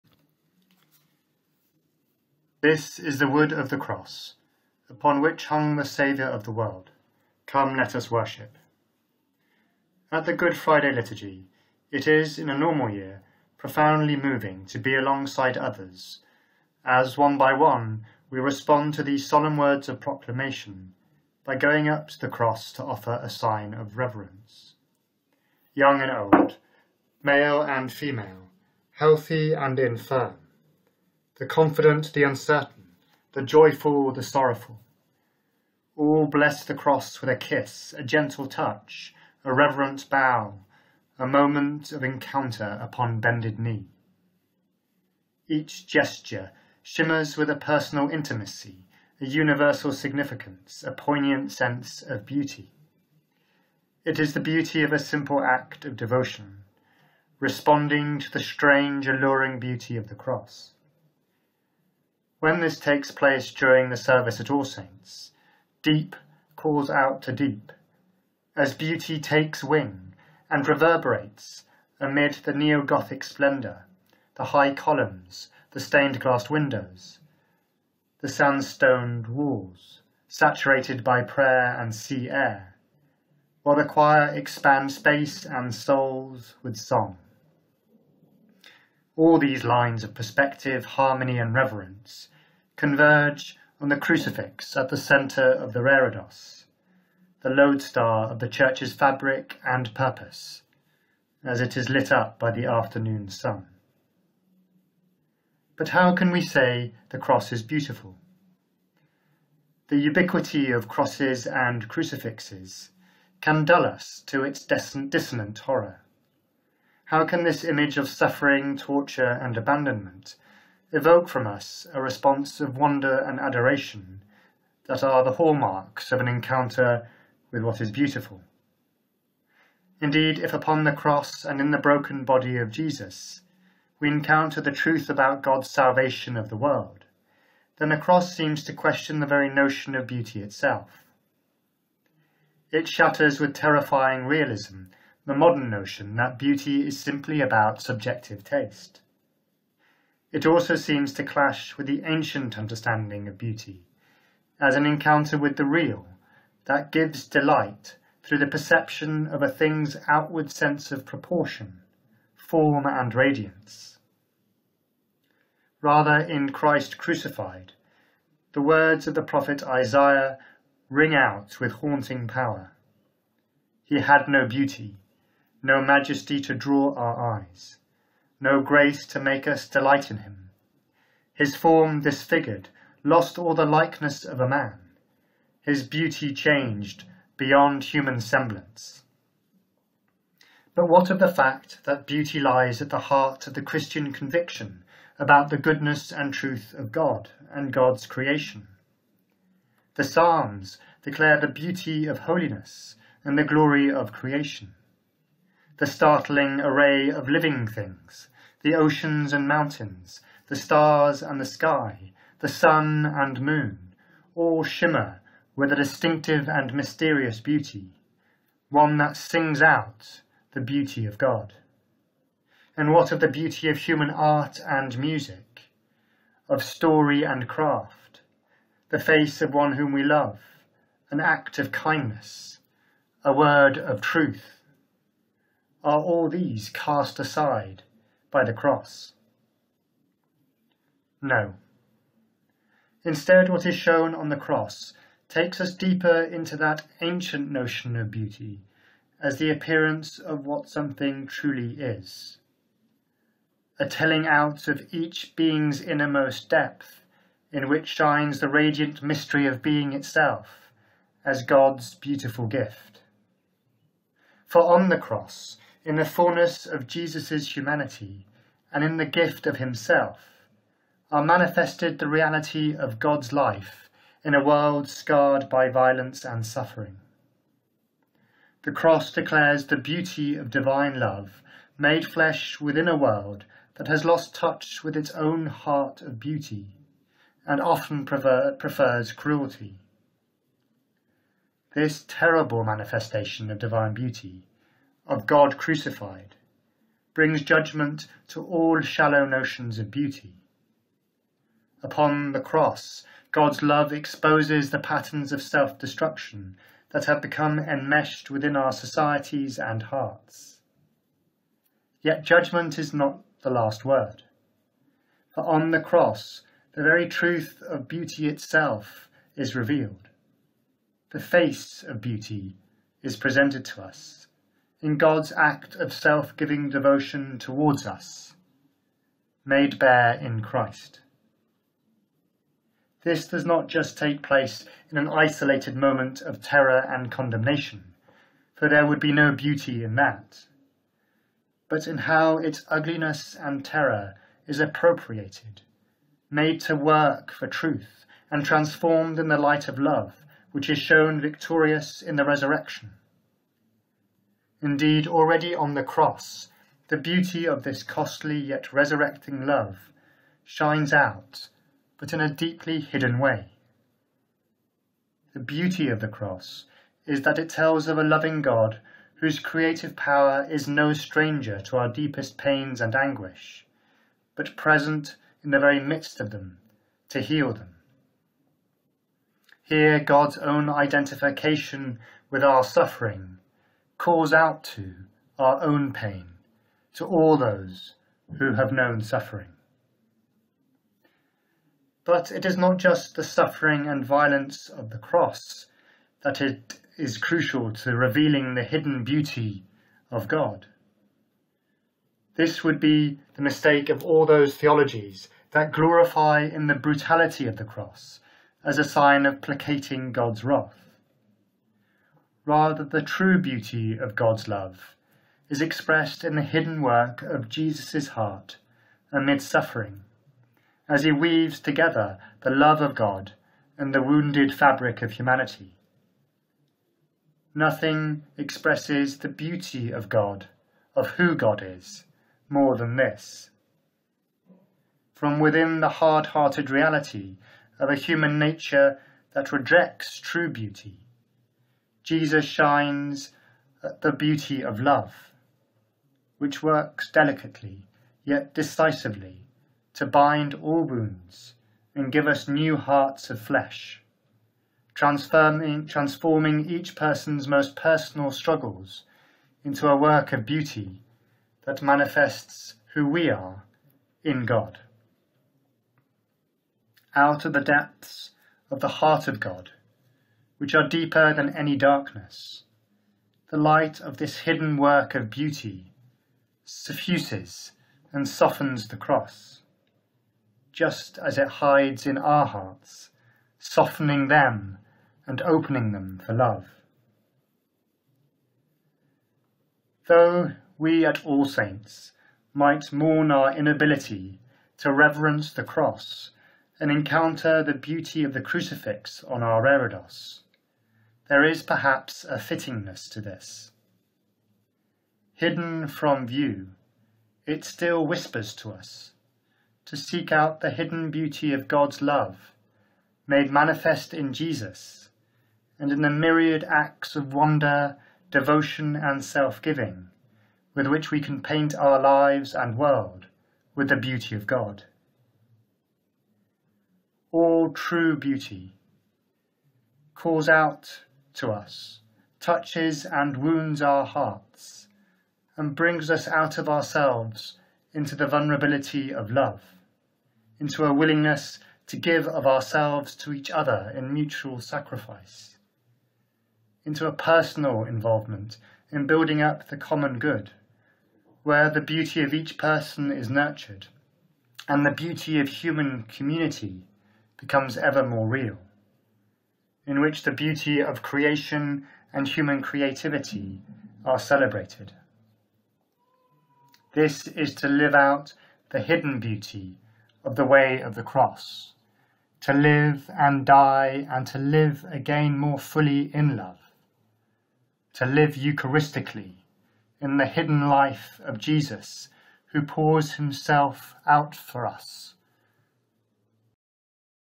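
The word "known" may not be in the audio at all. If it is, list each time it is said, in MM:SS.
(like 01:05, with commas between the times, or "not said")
06:28.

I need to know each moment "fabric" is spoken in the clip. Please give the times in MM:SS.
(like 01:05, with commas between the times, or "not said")
01:38, 07:04.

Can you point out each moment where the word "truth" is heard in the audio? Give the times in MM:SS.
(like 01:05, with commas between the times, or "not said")
02:14, 03:16, 03:54, 05:17, 05:47.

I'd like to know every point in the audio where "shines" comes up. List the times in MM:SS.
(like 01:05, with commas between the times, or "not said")
04:17, 06:00, 07:22.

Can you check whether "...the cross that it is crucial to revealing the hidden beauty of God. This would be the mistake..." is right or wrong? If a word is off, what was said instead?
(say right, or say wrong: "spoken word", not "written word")
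right.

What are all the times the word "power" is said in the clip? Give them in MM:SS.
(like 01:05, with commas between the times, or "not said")
02:52, 06:09.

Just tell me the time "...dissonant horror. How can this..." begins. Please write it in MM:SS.
01:54.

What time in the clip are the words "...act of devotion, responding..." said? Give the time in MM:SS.
00:55.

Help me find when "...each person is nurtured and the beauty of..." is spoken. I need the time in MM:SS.
09:12.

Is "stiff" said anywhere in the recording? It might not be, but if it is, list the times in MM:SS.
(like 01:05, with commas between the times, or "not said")
not said.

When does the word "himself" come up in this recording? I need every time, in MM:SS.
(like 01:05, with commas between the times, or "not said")
04:29, 09:43.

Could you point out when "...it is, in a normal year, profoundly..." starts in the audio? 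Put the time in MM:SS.
00:11.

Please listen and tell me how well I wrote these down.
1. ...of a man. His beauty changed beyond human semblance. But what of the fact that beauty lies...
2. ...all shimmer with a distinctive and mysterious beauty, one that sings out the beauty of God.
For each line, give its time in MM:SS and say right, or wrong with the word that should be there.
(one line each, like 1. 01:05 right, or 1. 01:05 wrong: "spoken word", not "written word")
1. 03:04 right
2. 03:34 right.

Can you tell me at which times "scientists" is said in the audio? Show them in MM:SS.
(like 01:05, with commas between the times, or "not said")
not said.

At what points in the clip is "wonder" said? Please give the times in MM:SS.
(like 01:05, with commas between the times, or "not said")
02:02, 08:37.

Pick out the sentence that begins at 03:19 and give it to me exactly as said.
The Psalms declare the beauty of holiness and the glory of creation.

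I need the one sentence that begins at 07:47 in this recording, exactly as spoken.
Out of the depths of the heart of God, which are deeper than any darkness.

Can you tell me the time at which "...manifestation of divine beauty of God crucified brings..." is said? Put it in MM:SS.
04:52.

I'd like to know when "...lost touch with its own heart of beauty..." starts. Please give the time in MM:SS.
04:44.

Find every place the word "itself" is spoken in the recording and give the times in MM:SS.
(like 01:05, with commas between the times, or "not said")
02:20, 04:19, 05:18.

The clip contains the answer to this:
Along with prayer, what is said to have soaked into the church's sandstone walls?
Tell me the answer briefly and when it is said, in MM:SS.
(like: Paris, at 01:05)
sea air, at 01:21.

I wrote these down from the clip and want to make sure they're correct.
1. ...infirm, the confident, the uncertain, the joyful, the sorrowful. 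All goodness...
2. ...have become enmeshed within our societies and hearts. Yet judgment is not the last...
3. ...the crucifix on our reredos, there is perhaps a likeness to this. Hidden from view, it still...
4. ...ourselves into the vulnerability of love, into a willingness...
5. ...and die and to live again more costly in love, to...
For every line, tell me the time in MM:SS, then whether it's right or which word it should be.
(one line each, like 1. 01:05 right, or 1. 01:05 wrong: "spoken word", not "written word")
1. 00:29 wrong: "bless", not "goodness"
2. 05:07 right
3. 08:18 wrong: "fittingness", not "likeness"
4. 08:56 right
5. 09:33 wrong: "fully", not "costly".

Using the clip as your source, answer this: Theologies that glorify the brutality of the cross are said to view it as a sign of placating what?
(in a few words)
God's wrath.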